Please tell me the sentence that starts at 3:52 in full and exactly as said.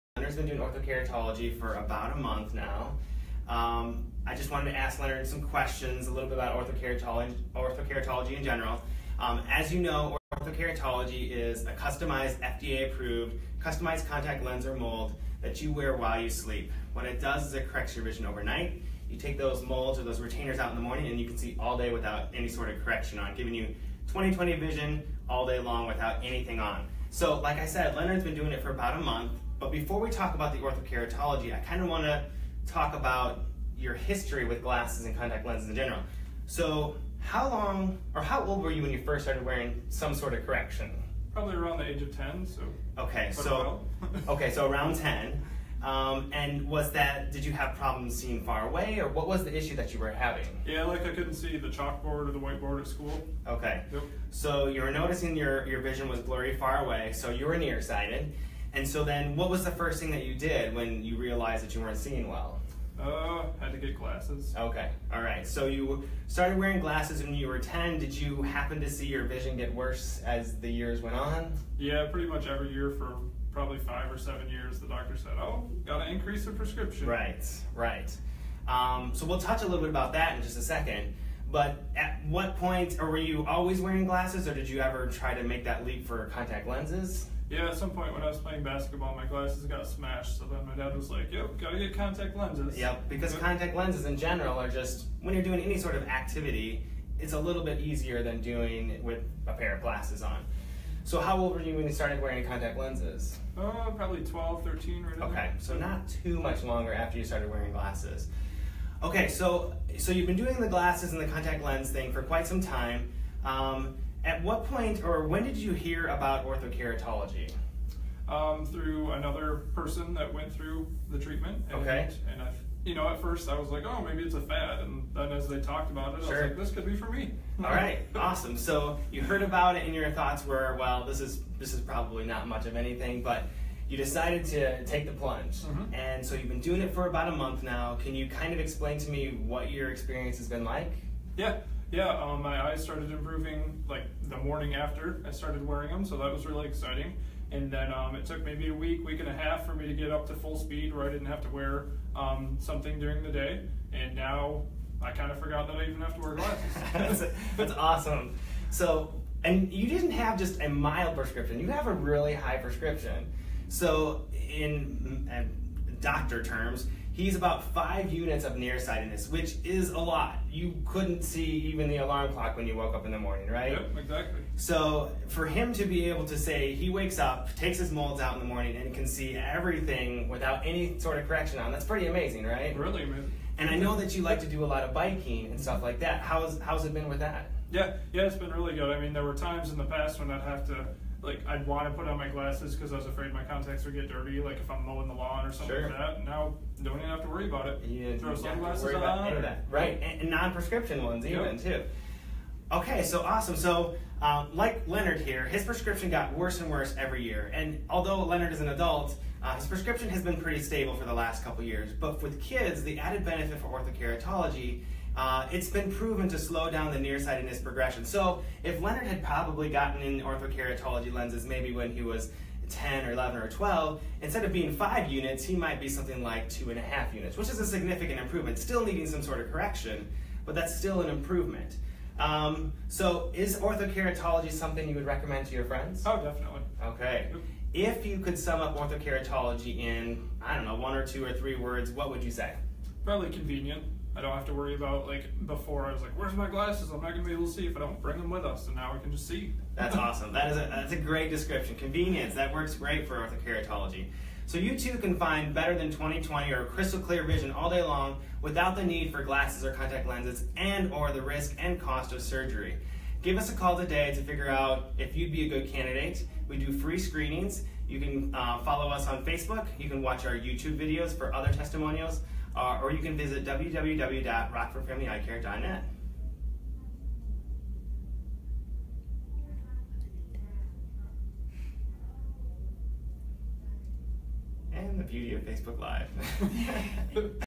Um, so is orthokeratology something you would recommend to your friends?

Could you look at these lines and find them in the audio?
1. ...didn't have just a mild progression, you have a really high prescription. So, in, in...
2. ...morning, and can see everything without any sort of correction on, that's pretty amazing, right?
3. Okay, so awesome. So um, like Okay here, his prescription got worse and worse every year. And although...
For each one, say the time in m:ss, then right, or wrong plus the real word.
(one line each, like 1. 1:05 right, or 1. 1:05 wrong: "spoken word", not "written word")
1. 2:39 wrong: "prescription", not "progression"
2. 2:58 right
3. 3:22 wrong: "Leonard", not "Okay".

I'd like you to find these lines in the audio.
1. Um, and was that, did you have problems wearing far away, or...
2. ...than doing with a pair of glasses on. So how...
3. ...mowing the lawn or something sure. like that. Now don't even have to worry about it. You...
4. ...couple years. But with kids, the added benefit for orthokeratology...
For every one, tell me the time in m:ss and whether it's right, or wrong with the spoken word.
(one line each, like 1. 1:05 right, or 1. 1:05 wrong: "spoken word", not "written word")
1. 0:45 wrong: "seeing", not "wearing"
2. 1:38 right
3. 3:14 right
4. 3:31 right.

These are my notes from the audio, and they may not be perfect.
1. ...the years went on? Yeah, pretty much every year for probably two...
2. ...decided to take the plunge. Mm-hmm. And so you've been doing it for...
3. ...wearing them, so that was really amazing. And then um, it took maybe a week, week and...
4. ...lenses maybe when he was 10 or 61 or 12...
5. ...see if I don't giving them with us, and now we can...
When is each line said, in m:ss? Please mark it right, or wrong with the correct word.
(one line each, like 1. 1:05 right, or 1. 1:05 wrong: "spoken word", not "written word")
1. 1:10 wrong: "five", not "two"
2. 2:13 right
3. 2:25 wrong: "exciting", not "amazing"
4. 3:41 wrong: "11", not "61"
5. 4:07 wrong: "bring", not "giving".